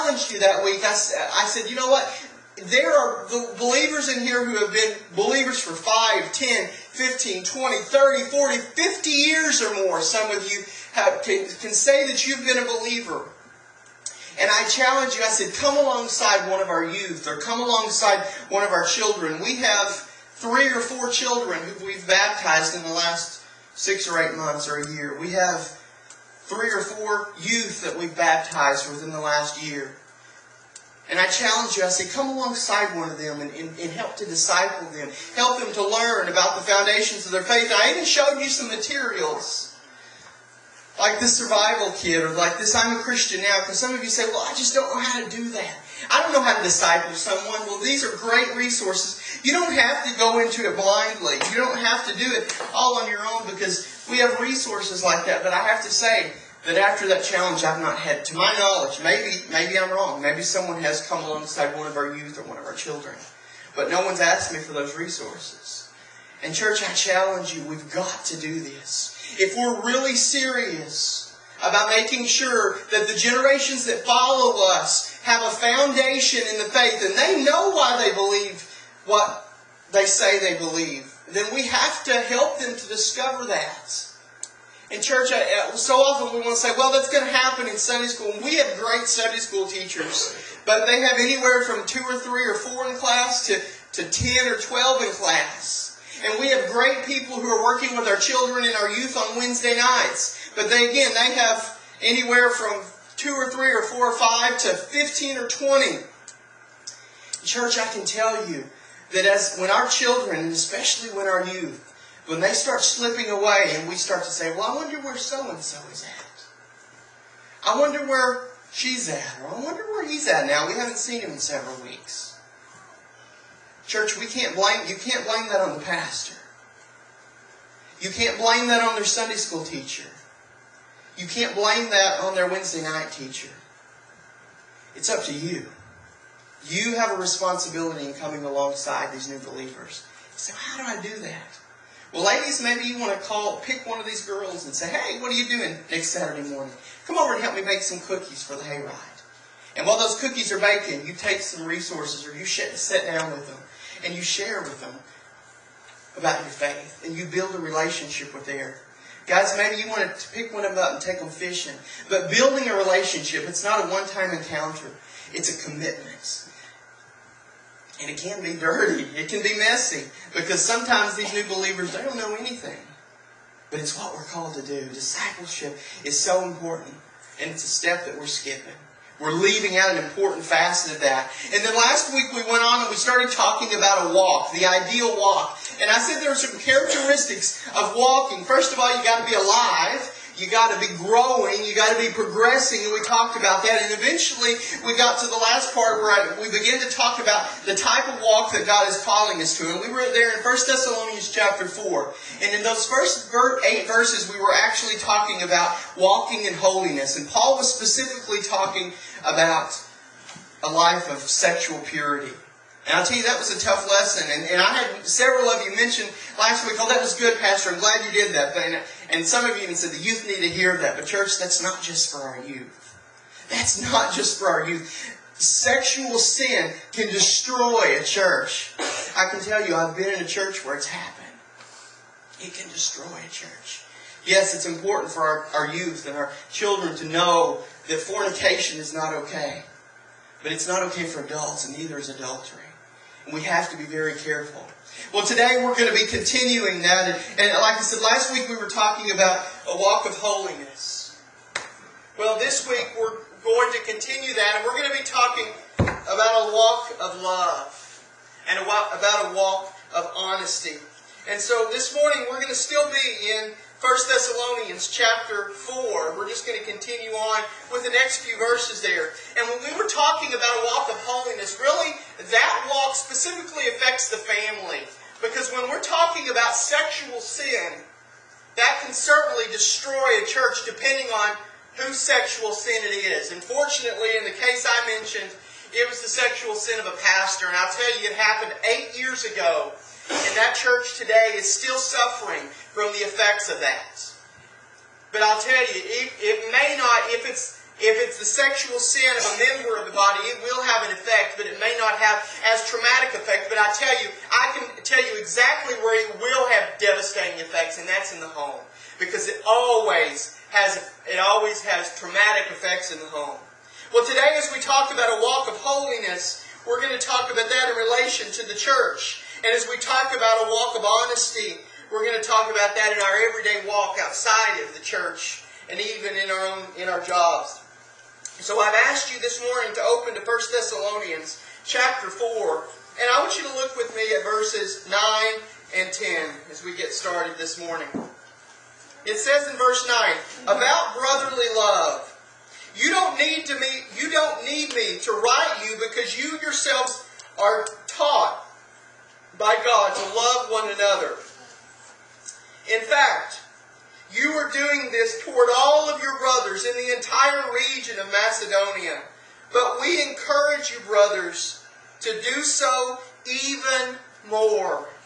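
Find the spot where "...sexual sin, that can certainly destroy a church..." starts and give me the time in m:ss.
4:36.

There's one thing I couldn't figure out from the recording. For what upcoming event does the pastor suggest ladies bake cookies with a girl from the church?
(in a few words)
the hayride.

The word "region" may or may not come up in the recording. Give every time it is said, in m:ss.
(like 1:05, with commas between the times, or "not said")
5:57.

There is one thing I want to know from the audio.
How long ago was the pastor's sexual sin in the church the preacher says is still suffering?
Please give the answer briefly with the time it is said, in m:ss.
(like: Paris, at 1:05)
8 years, at 4:48.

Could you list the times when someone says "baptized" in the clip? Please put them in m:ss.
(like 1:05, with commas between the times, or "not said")
0:22, 0:28.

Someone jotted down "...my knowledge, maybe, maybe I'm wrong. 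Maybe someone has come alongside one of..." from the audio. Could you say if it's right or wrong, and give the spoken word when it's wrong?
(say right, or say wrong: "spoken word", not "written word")
right.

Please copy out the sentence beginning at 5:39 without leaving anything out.
It says in verse 9, about brotherly love.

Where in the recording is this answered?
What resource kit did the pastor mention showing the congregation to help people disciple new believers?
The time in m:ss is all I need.
0:41.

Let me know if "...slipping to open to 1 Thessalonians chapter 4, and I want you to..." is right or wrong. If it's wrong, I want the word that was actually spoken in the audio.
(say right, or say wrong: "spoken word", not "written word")
wrong: "morning", not "slipping".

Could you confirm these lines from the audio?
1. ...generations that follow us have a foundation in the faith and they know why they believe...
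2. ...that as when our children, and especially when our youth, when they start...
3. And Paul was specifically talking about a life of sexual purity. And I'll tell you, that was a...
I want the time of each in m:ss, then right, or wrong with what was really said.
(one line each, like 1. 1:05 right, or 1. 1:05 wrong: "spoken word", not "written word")
1. 1:13 right
2. 1:49 right
3. 3:27 right.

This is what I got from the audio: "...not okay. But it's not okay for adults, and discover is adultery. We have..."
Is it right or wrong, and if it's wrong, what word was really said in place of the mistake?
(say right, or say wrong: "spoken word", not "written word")
wrong: "neither", not "discover".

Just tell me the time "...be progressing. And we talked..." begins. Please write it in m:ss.
3:12.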